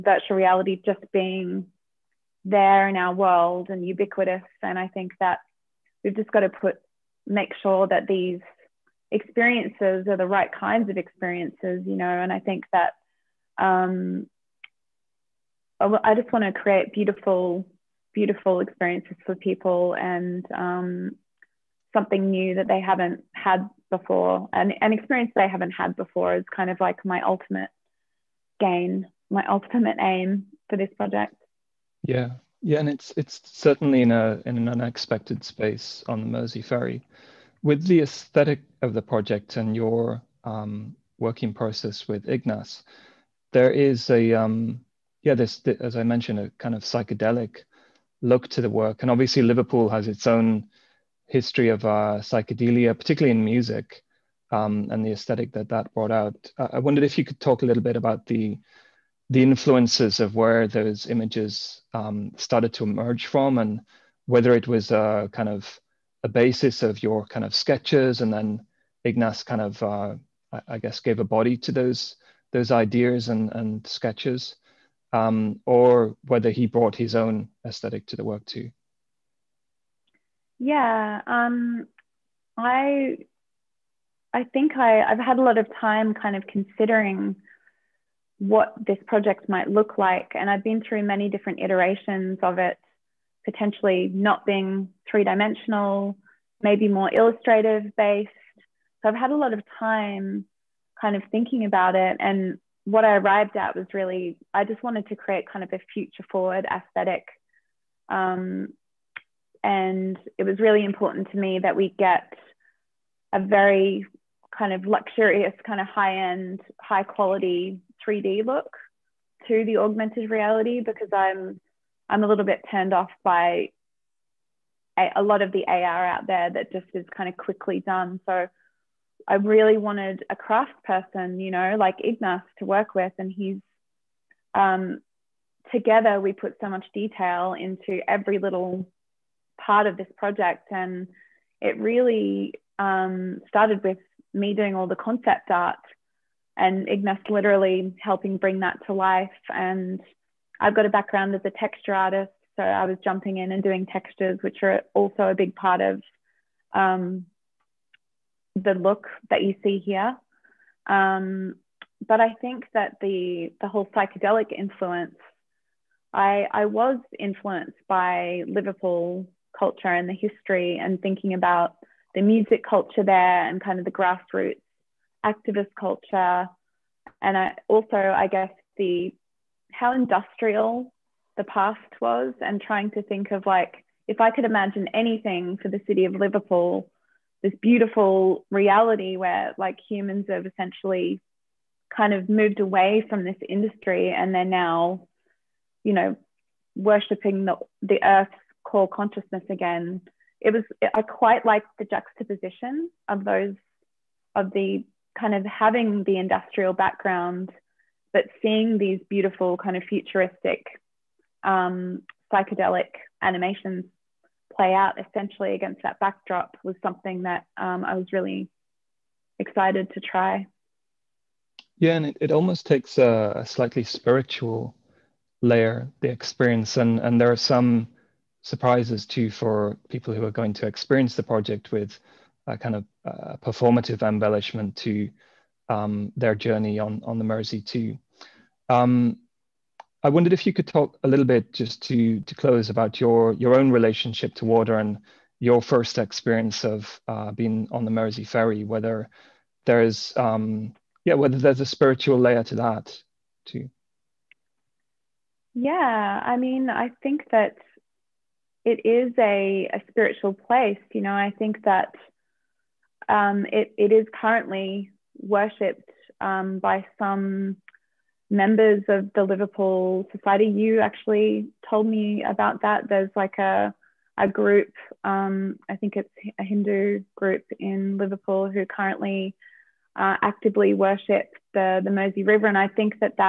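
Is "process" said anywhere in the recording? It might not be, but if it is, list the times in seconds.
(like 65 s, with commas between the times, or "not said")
41 s.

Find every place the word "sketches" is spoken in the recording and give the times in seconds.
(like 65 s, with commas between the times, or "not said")
67 s, 73 s.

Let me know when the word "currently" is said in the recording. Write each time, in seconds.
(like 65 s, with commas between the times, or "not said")
264 s, 278 s.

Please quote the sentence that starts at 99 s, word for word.
So I've had a lot of time kind of thinking about it.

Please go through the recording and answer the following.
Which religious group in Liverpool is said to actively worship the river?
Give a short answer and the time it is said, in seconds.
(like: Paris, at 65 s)
A Hindu group, at 276 s.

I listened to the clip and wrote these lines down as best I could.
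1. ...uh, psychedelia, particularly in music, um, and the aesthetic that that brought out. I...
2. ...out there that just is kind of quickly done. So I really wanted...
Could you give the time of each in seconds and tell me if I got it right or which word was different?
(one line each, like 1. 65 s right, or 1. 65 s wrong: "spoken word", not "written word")
1. 51 s right
2. 126 s right.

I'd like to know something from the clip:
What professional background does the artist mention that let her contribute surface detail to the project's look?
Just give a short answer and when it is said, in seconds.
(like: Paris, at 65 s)
Texture artist, at 151 s.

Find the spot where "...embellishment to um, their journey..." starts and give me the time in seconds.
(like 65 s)
234 s.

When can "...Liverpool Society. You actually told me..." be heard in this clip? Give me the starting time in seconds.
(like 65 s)
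269 s.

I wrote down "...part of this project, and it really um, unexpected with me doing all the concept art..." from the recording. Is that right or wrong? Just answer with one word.
wrong.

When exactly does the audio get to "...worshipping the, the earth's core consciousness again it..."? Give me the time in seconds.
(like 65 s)
196 s.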